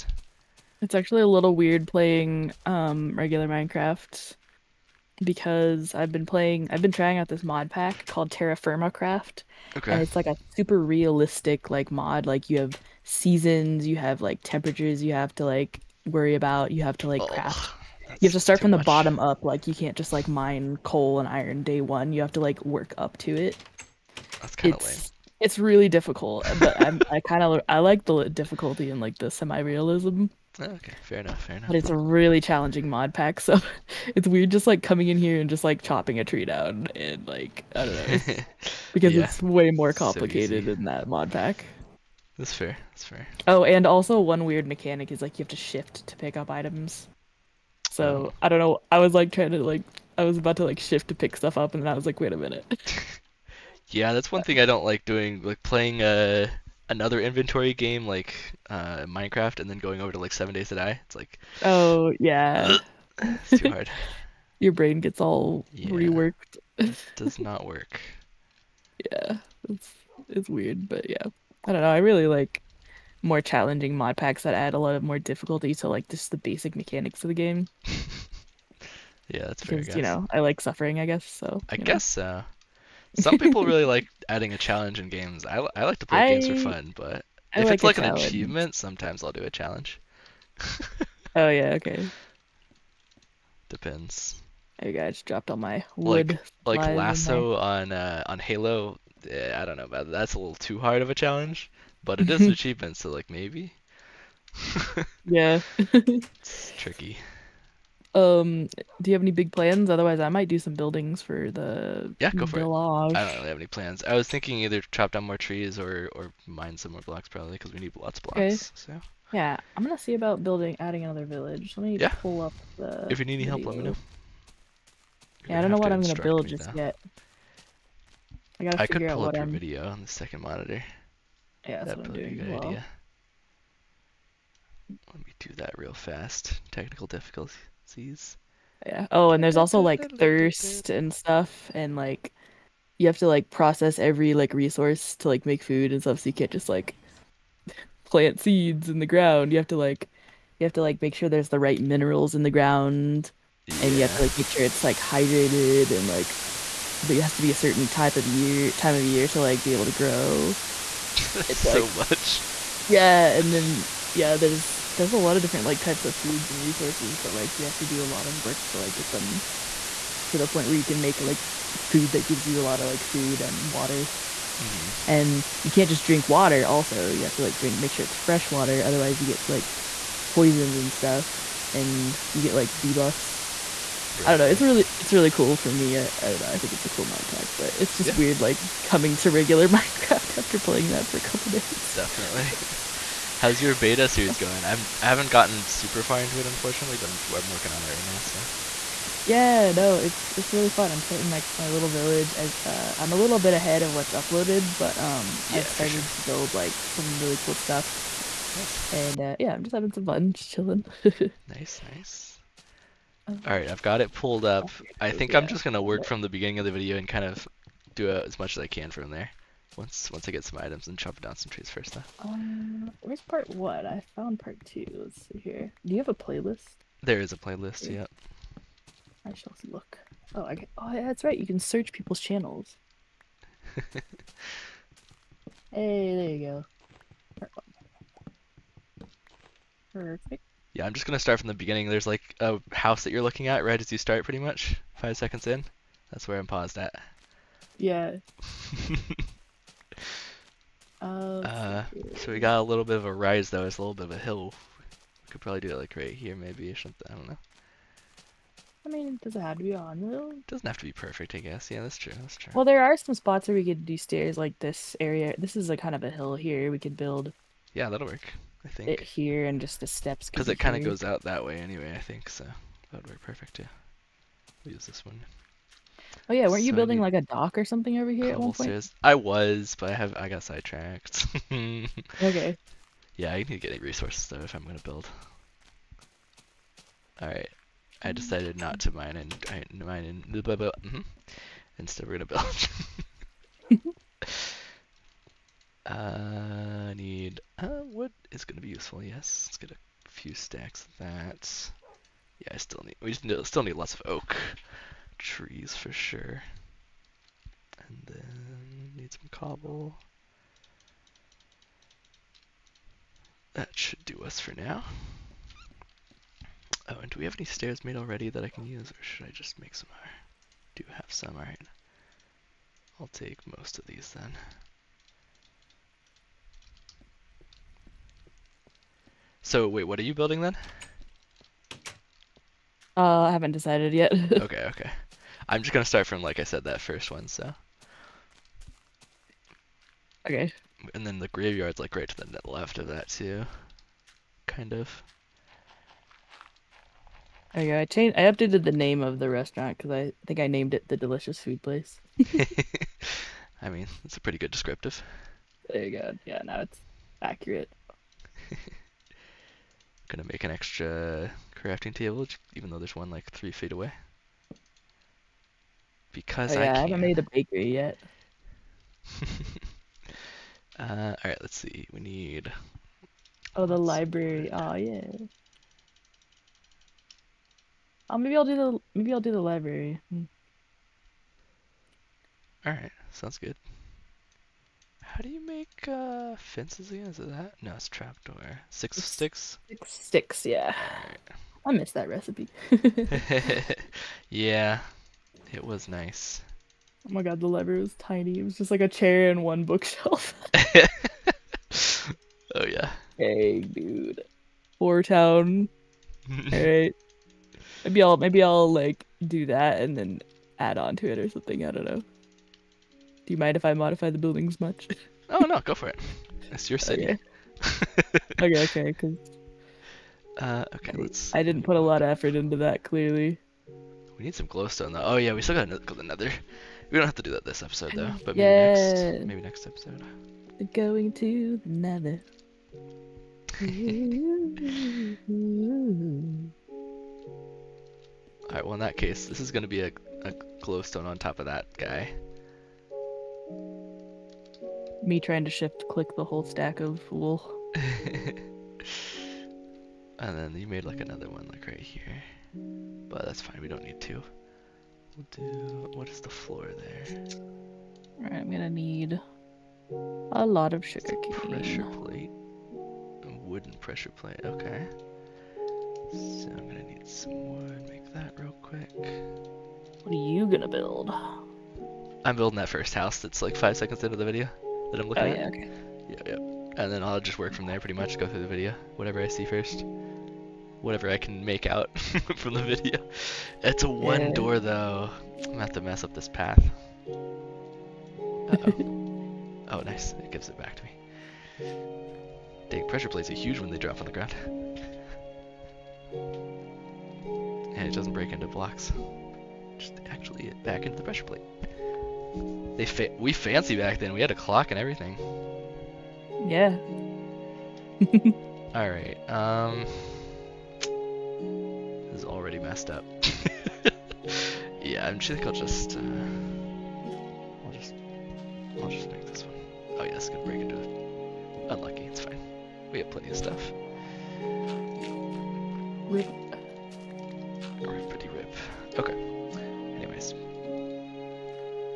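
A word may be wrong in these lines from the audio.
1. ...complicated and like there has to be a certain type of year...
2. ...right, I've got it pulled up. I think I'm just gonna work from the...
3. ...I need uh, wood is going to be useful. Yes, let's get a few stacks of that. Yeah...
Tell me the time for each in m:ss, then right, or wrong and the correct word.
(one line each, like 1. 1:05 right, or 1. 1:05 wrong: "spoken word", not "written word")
1. 2:34 wrong: "hydrated", not "complicated"
2. 3:33 right
3. 4:56 right.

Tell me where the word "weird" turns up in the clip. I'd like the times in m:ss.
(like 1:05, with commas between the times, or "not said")
0:01, 0:34, 0:44, 1:10, 3:08.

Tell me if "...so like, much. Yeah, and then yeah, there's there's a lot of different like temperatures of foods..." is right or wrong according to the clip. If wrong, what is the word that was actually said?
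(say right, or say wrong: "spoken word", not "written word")
wrong: "types", not "temperatures".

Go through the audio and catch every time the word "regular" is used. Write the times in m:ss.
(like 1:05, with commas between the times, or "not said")
0:03, 3:09.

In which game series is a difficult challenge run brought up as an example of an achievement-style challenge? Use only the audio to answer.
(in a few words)
Halo.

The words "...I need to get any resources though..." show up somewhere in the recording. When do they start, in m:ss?
4:43.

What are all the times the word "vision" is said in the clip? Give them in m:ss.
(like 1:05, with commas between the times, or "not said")
not said.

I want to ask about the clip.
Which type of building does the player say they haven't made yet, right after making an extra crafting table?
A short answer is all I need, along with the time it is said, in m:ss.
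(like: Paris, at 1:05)
bakery, at 6:07.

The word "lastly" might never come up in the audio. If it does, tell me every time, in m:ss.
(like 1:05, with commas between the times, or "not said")
not said.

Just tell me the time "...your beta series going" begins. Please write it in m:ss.
3:13.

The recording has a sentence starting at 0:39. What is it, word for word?
it's way more complicated so that mod pack.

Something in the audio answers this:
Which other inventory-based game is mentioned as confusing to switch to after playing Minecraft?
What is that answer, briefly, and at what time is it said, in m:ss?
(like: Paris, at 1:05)
Seven Days to Die, at 1:00.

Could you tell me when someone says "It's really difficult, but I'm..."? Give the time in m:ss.
0:25.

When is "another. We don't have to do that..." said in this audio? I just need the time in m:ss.
7:05.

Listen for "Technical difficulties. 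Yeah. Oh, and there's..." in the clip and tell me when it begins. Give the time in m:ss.
2:16.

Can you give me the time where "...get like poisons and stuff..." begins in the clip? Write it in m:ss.
2:59.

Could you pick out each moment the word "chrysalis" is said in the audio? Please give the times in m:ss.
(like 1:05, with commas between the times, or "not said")
not said.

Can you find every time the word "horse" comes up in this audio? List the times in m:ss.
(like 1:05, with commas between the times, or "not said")
not said.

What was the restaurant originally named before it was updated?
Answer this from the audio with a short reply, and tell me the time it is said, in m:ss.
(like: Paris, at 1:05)
the Delicious Food Place, at 5:50.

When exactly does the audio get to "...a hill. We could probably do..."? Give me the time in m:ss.
4:14.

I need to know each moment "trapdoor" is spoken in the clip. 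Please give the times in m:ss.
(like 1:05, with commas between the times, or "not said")
6:27.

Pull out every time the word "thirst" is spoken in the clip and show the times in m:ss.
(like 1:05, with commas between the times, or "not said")
2:20.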